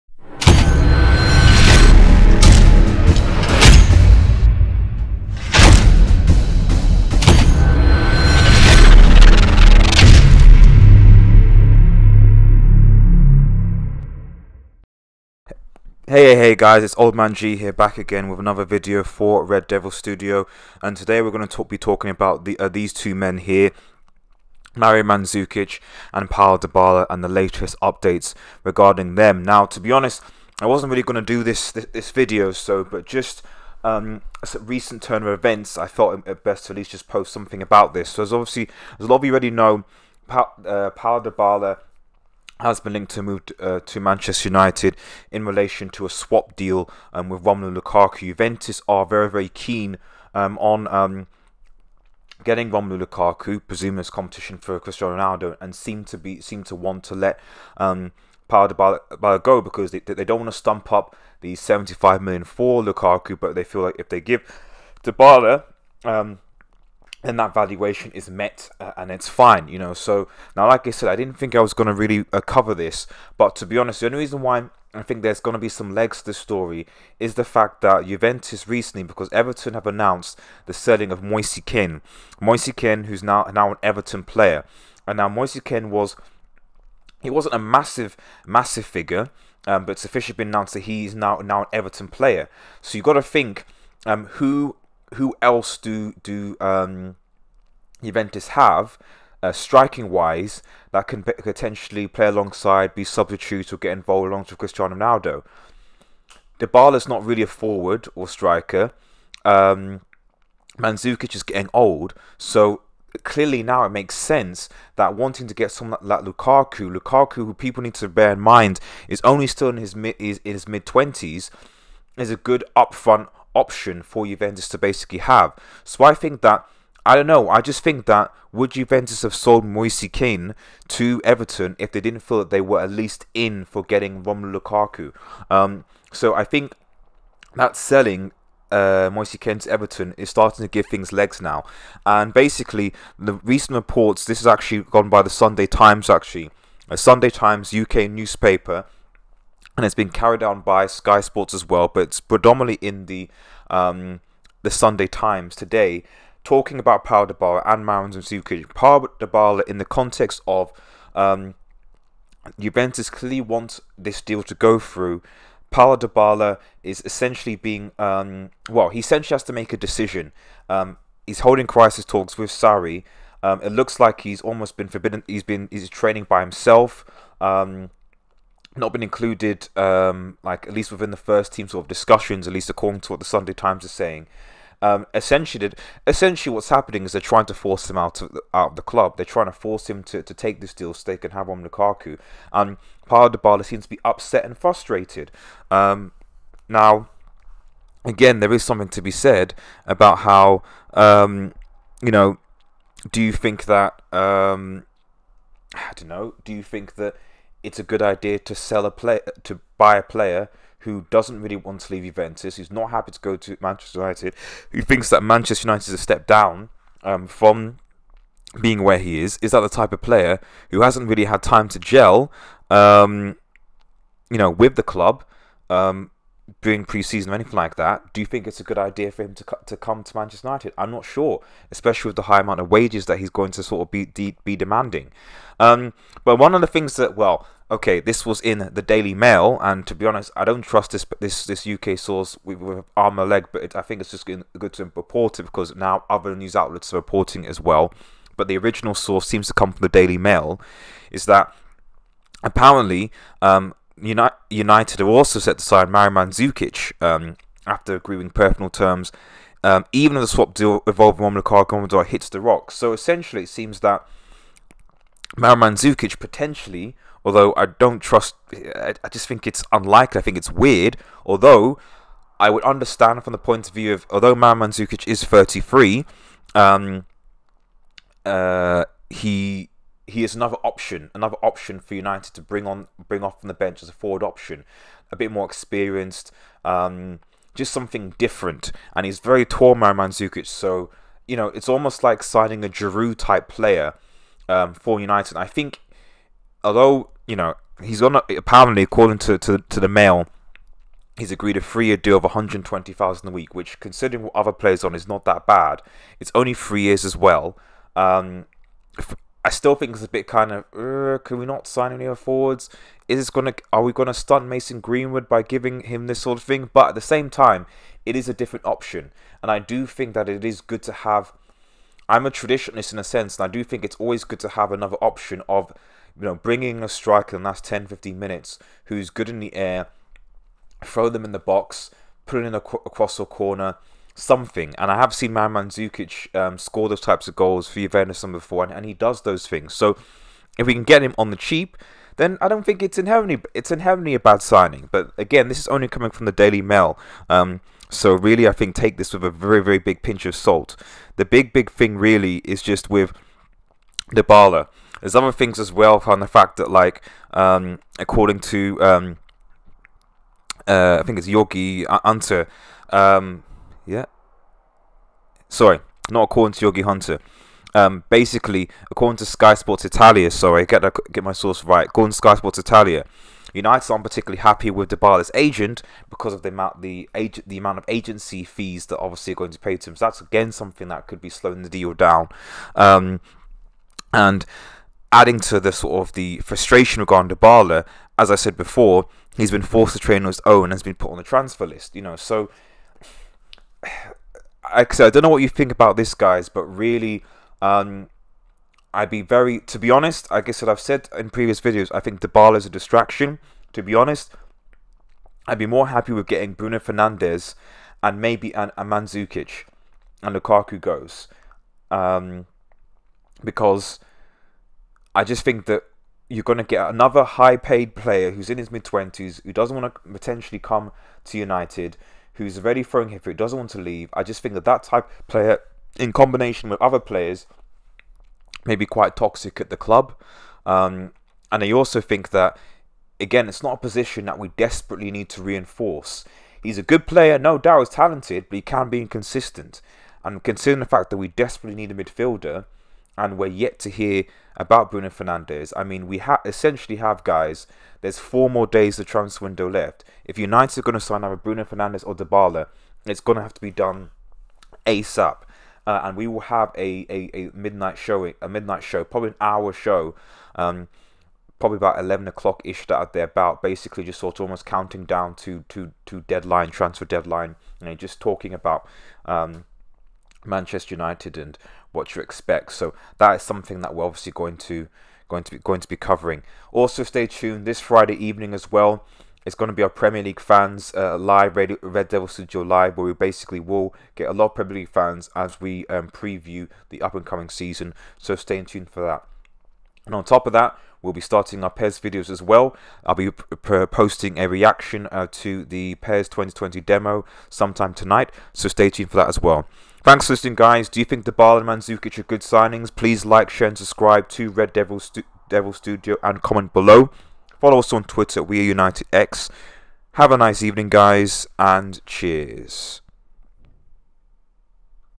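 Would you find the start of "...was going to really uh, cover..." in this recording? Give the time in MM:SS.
01:11.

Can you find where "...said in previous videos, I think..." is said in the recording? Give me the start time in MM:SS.
06:40.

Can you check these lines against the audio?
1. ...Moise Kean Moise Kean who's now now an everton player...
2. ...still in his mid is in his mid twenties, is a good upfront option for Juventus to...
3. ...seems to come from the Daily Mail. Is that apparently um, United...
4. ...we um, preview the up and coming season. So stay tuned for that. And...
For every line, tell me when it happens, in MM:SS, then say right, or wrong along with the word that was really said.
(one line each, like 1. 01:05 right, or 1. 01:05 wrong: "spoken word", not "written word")
1. 01:21 right
2. 01:59 right
3. 04:09 right
4. 08:05 right.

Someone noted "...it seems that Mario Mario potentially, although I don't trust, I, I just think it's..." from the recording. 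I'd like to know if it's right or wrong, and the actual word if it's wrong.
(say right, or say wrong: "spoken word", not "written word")
wrong: "Mandzukic", not "Mario".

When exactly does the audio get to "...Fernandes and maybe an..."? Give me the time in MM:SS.
06:46.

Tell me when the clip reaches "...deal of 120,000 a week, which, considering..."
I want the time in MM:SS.
05:01.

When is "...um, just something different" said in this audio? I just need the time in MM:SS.
04:46.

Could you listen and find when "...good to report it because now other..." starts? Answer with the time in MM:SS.
04:04.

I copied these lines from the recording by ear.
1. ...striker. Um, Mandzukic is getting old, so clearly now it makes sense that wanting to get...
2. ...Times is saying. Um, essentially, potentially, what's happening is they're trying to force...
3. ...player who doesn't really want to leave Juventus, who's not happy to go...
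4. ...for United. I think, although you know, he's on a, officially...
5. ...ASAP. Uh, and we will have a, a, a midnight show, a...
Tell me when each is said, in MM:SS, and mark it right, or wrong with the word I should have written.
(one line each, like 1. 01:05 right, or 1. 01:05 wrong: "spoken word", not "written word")
1. 01:48 right
2. 03:03 wrong: "essentially", not "potentially"
3. 03:30 right
4. 04:54 wrong: "apparently", not "officially"
5. 07:34 right.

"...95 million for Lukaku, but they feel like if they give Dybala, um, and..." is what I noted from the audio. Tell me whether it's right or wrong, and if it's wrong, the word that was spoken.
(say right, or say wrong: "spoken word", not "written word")
wrong: "75", not "95".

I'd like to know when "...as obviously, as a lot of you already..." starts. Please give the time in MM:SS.
00:38.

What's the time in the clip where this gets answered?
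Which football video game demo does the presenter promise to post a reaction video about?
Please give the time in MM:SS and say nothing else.
08:15.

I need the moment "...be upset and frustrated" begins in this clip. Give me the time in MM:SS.
03:13.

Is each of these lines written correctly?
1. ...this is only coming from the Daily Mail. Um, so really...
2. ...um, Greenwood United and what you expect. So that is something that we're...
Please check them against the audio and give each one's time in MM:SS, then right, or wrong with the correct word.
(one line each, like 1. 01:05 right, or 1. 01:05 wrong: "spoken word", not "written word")
1. 05:45 right
2. 07:49 wrong: "Manchester", not "Greenwood".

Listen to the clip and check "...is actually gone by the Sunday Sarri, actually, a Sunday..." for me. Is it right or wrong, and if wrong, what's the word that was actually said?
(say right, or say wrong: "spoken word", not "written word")
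wrong: "Times", not "Sarri".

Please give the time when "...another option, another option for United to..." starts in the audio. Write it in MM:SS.
04:40.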